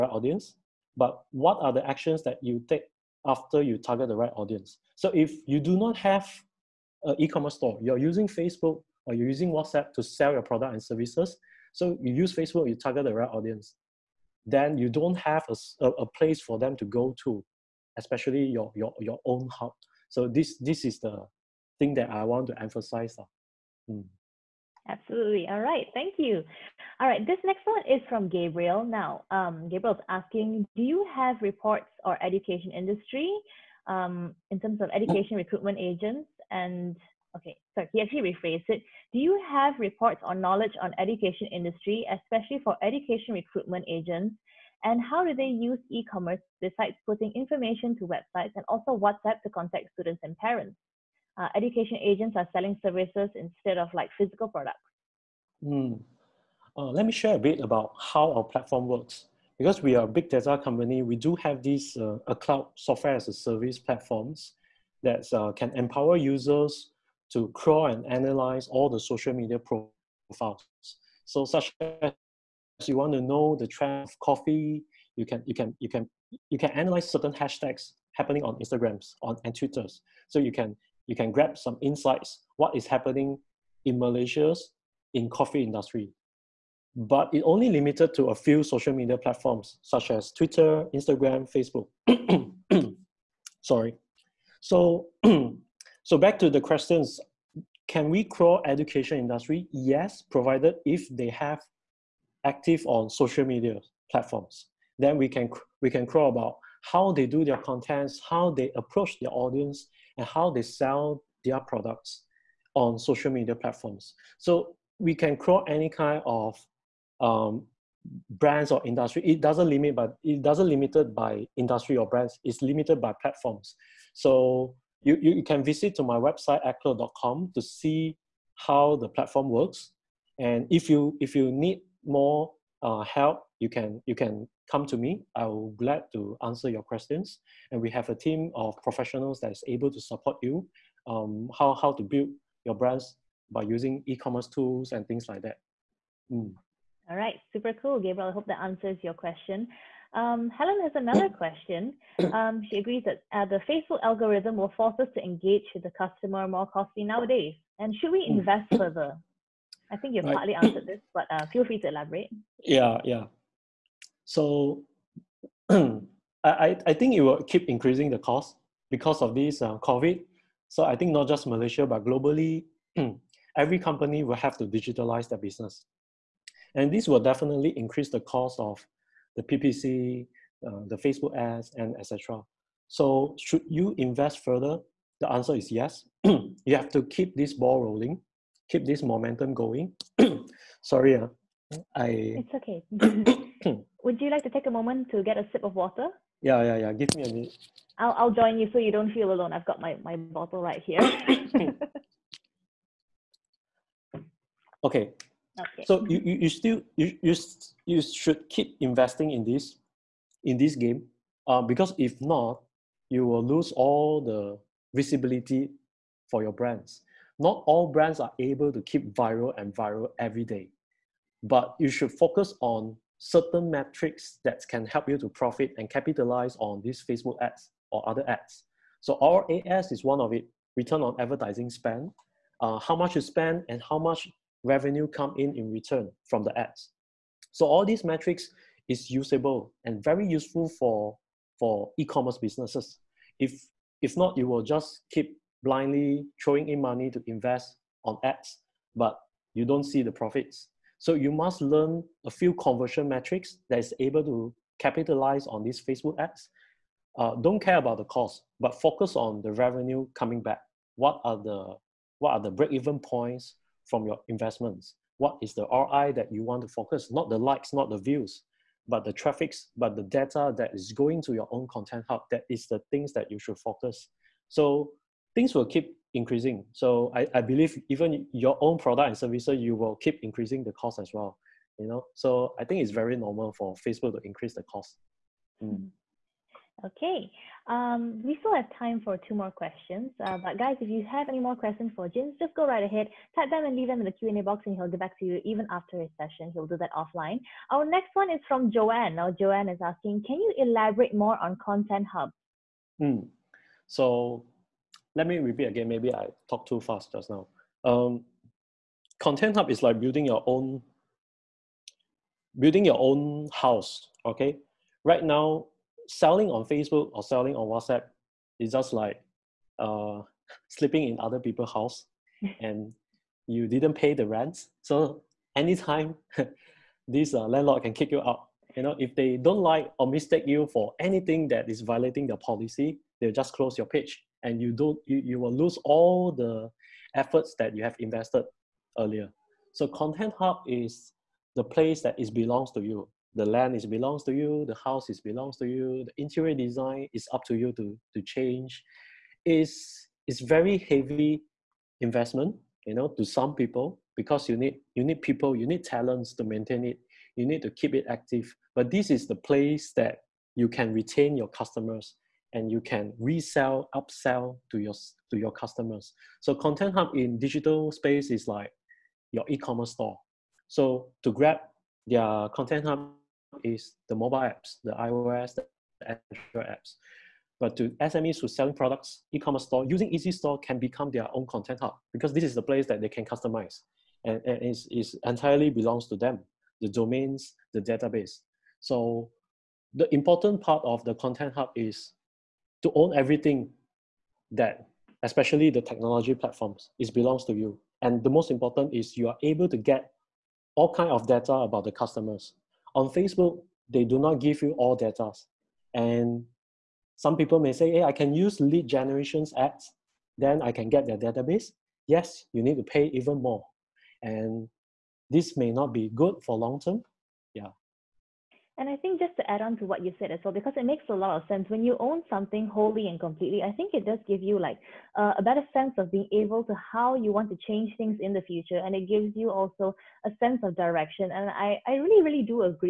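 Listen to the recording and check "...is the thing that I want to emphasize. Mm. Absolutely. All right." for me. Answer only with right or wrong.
right.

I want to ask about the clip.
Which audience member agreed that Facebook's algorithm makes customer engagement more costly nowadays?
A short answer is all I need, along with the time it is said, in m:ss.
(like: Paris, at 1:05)
Helen, at 2:30.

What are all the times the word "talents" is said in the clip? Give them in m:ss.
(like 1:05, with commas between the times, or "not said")
5:55.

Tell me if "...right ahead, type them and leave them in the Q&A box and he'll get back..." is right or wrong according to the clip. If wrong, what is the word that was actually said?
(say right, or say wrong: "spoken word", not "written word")
right.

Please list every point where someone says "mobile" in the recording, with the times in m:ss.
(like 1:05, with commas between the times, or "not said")
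6:14.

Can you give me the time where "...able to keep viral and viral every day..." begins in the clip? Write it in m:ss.
3:38.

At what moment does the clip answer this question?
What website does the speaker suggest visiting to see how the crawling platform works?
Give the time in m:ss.
2:06.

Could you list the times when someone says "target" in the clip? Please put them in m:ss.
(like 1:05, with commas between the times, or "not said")
0:03, 0:12.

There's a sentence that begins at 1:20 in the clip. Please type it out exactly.
So you can you can grab some insights what is happening in Malaysia's in coffee industry.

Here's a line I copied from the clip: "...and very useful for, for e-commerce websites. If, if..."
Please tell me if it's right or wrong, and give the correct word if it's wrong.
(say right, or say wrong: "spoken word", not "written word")
wrong: "businesses", not "websites".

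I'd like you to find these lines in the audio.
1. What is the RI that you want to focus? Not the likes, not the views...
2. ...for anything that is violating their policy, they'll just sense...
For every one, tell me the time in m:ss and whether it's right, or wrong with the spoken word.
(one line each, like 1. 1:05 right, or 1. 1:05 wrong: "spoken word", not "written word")
1. 4:25 right
2. 5:30 wrong: "close", not "sense".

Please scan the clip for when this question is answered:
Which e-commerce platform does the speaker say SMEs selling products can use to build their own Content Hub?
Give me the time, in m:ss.
6:20.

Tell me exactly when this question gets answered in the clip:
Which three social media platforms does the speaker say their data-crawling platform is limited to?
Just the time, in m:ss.
1:30.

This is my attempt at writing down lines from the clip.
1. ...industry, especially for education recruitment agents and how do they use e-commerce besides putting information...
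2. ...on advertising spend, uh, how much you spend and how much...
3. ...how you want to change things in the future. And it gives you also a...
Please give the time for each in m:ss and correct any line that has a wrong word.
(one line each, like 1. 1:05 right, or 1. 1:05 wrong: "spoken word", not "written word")
1. 0:41 right
2. 3:51 right
3. 7:06 right.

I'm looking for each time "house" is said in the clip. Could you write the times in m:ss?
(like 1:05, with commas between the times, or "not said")
5:13, 5:21, 5:44.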